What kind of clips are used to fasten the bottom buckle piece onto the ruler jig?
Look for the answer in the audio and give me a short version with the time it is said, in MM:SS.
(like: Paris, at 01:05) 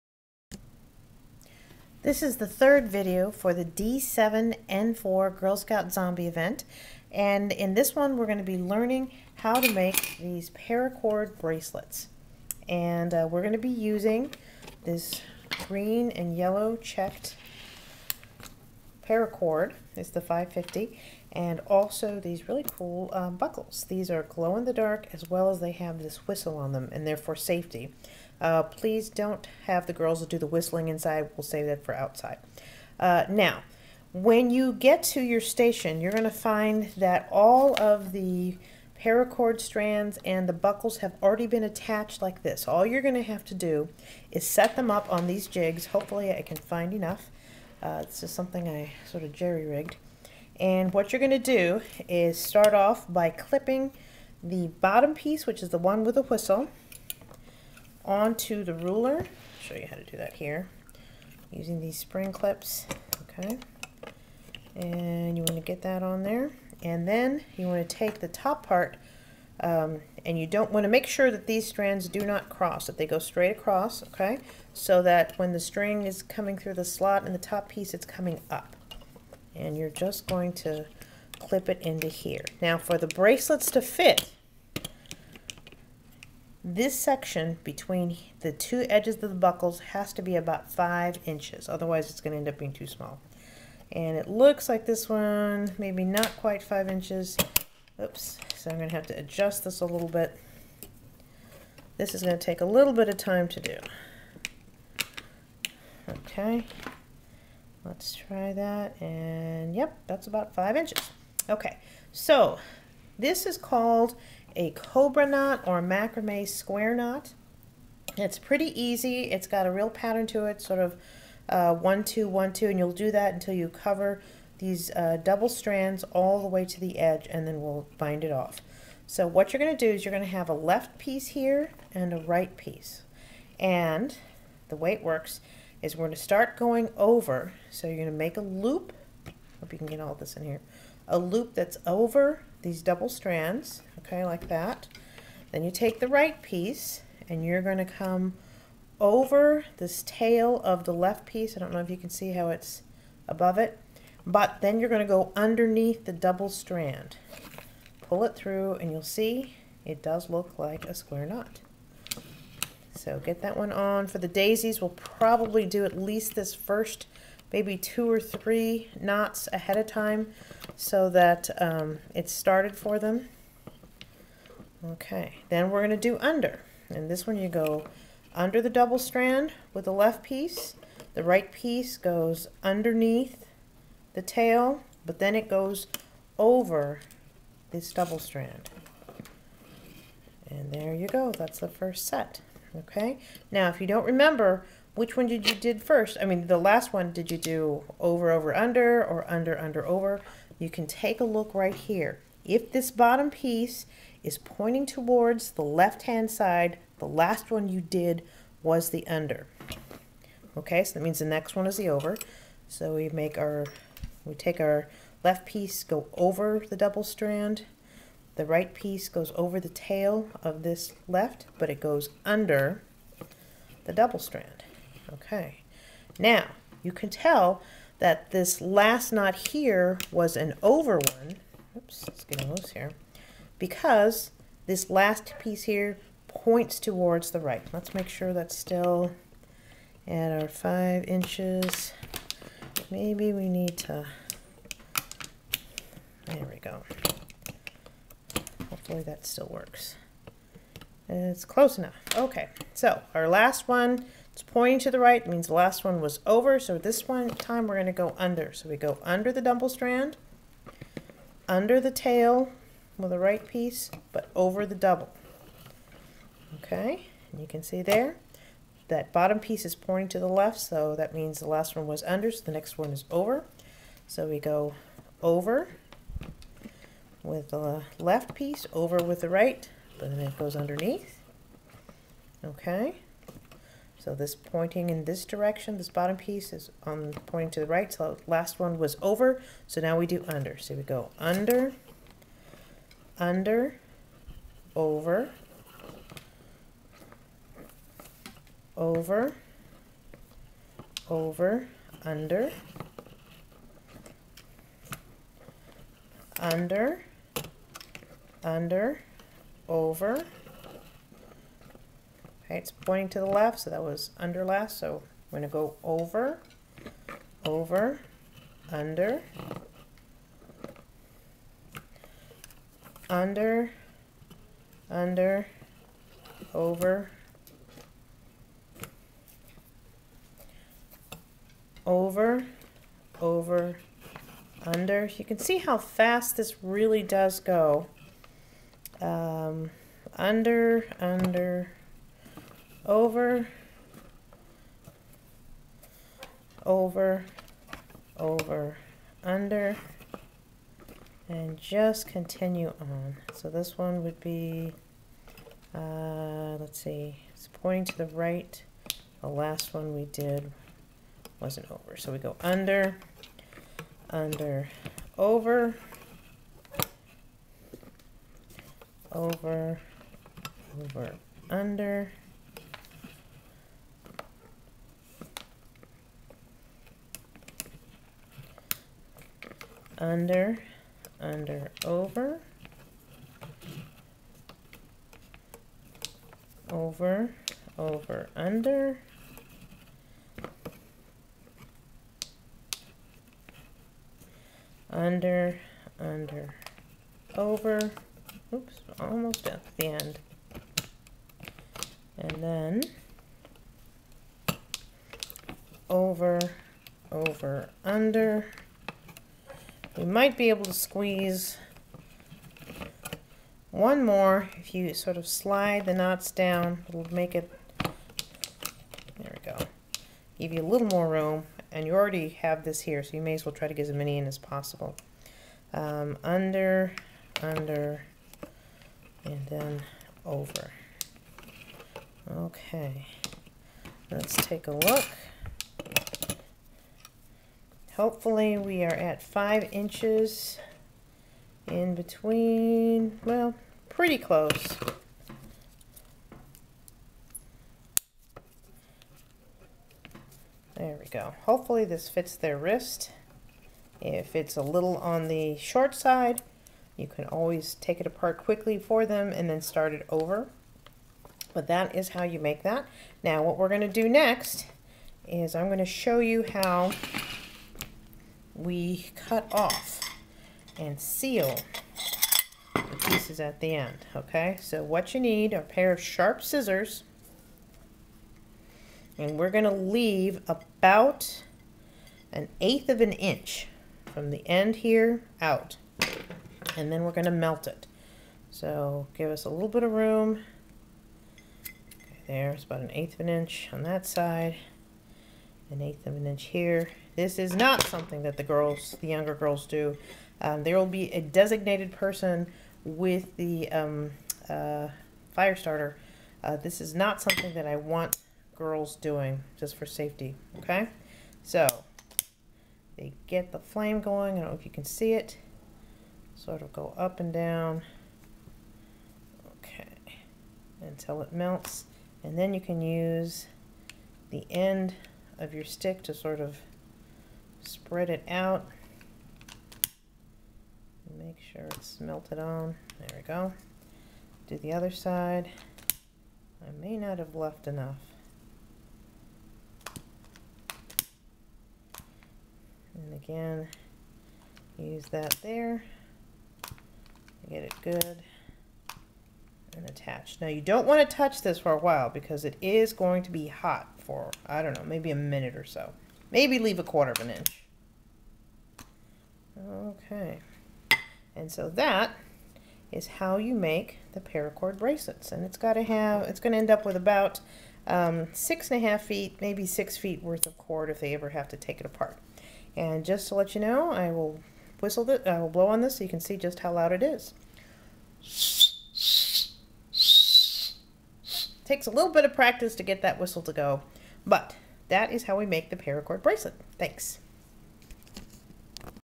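spring clips, at 01:01.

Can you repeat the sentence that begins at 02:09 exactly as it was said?
So what you're going to do is you're going to have a left piece here and a right piece.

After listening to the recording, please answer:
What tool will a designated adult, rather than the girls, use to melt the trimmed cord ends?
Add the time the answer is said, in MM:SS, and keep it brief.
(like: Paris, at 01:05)
fire starter, at 08:25.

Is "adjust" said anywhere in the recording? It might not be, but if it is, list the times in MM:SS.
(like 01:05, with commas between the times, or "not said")
01:39.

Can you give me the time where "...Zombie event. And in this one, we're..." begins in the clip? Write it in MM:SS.
00:05.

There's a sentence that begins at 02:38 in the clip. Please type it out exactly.
Pull it through and you'll see it does look like a square knot.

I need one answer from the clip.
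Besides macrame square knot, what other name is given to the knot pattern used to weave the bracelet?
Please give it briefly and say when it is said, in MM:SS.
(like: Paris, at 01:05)
cobra knot, at 01:54.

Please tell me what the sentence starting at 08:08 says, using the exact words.
So give us a little bit of room.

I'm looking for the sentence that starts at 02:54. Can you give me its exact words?
Okay, then we're going to do under.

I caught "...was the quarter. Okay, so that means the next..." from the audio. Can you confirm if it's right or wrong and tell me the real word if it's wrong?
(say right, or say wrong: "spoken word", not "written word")
wrong: "under", not "quarter".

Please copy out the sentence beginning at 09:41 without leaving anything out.
takes a little bit of practice to get that whistle to go, but that is how we make the paracord bracelet.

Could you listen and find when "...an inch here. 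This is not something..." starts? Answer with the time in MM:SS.
08:16.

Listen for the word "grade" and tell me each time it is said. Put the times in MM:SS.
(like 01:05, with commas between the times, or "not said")
not said.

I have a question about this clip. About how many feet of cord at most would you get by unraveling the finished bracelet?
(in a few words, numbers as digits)
6.5 feet.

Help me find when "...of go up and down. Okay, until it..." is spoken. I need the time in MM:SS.
08:36.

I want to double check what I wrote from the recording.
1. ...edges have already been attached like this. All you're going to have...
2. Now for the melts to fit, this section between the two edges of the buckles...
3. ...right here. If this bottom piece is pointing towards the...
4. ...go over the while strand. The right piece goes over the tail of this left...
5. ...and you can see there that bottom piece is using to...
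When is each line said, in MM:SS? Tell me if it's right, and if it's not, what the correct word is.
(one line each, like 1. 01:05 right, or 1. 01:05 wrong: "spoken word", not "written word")
1. 00:40 wrong: "buckles", not "edges"
2. 01:22 wrong: "bracelets", not "melts"
3. 03:21 right
4. 03:35 wrong: "double", not "while"
5. 04:27 wrong: "pointing", not "using".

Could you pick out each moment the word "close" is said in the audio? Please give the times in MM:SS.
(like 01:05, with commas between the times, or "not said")
04:11, 07:24.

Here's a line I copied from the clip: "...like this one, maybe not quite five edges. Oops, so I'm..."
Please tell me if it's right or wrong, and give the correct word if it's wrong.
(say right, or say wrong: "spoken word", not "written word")
wrong: "inches", not "edges".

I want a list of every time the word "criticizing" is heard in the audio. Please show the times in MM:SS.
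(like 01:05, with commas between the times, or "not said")
not said.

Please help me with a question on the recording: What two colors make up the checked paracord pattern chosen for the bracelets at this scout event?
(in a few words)
green and yellow.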